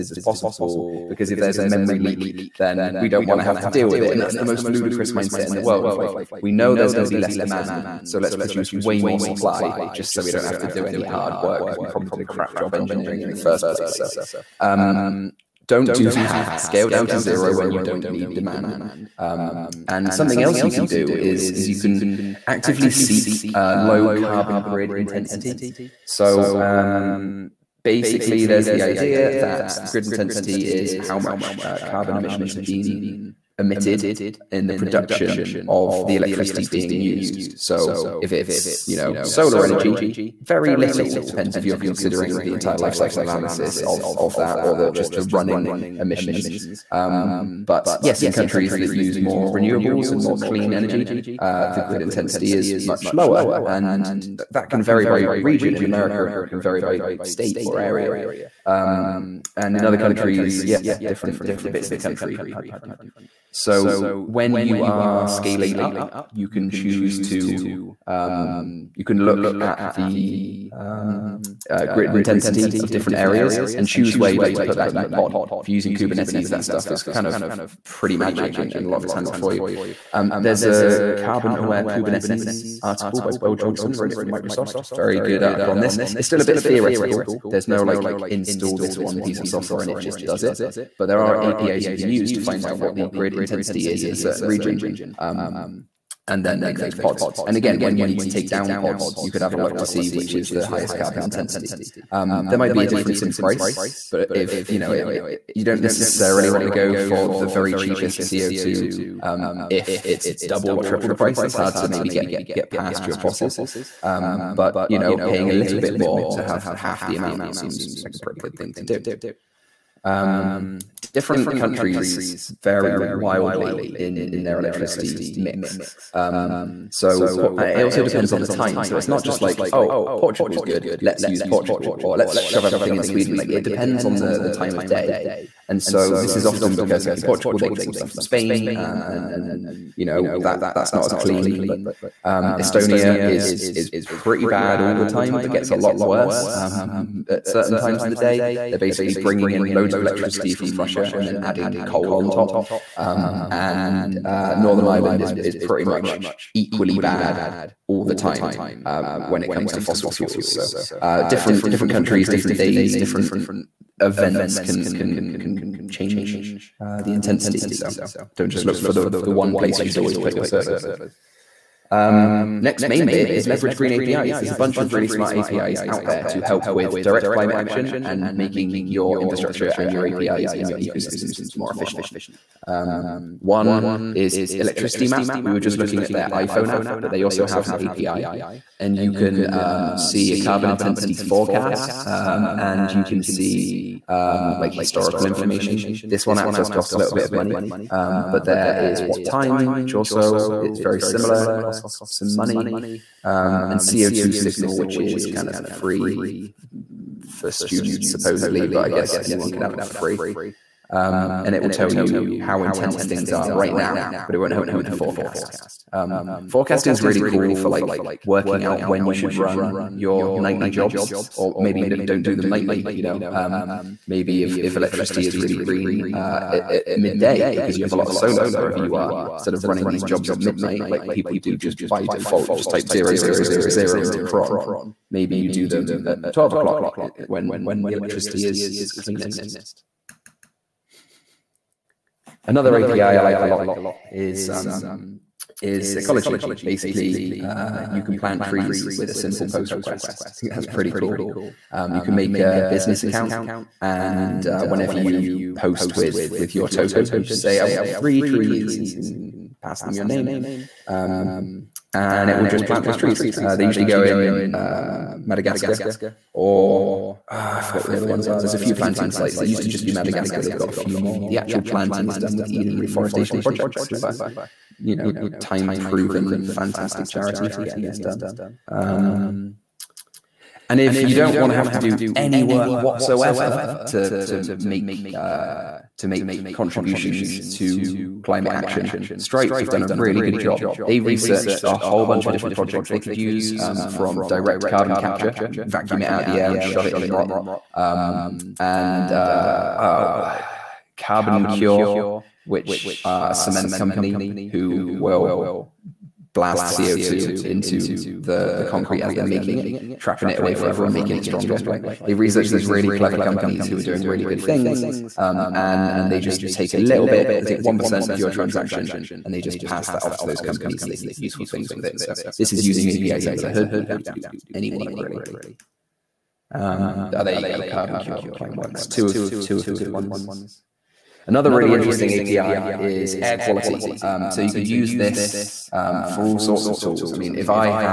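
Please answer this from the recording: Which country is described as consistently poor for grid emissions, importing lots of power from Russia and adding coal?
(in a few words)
Estonia.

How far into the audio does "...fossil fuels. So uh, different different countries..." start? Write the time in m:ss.
2:39.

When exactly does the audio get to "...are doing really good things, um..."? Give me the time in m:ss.
5:13.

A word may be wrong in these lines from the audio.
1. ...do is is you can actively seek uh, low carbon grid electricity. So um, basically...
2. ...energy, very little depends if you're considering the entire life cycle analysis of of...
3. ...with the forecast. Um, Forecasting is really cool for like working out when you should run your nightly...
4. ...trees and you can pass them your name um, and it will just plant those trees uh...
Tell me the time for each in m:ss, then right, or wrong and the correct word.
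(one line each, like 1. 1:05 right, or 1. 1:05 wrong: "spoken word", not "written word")
1. 0:20 wrong: "intensity", not "electricity"
2. 0:39 right
3. 3:34 right
4. 4:18 right.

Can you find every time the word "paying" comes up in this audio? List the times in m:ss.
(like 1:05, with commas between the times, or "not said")
1:55.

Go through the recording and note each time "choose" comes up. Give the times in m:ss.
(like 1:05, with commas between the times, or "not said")
1:06, 1:13.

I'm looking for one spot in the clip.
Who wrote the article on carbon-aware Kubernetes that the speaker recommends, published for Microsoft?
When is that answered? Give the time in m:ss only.
1:23.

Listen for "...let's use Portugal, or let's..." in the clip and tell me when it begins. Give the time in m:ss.
2:10.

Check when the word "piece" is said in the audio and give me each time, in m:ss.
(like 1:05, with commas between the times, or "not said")
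1:29.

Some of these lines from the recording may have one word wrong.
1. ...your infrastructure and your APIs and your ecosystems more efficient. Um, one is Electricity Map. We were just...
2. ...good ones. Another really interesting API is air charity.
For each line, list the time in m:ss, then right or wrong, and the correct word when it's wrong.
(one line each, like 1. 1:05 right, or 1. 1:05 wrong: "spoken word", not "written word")
1. 2:58 right
2. 5:29 wrong: "quality", not "charity".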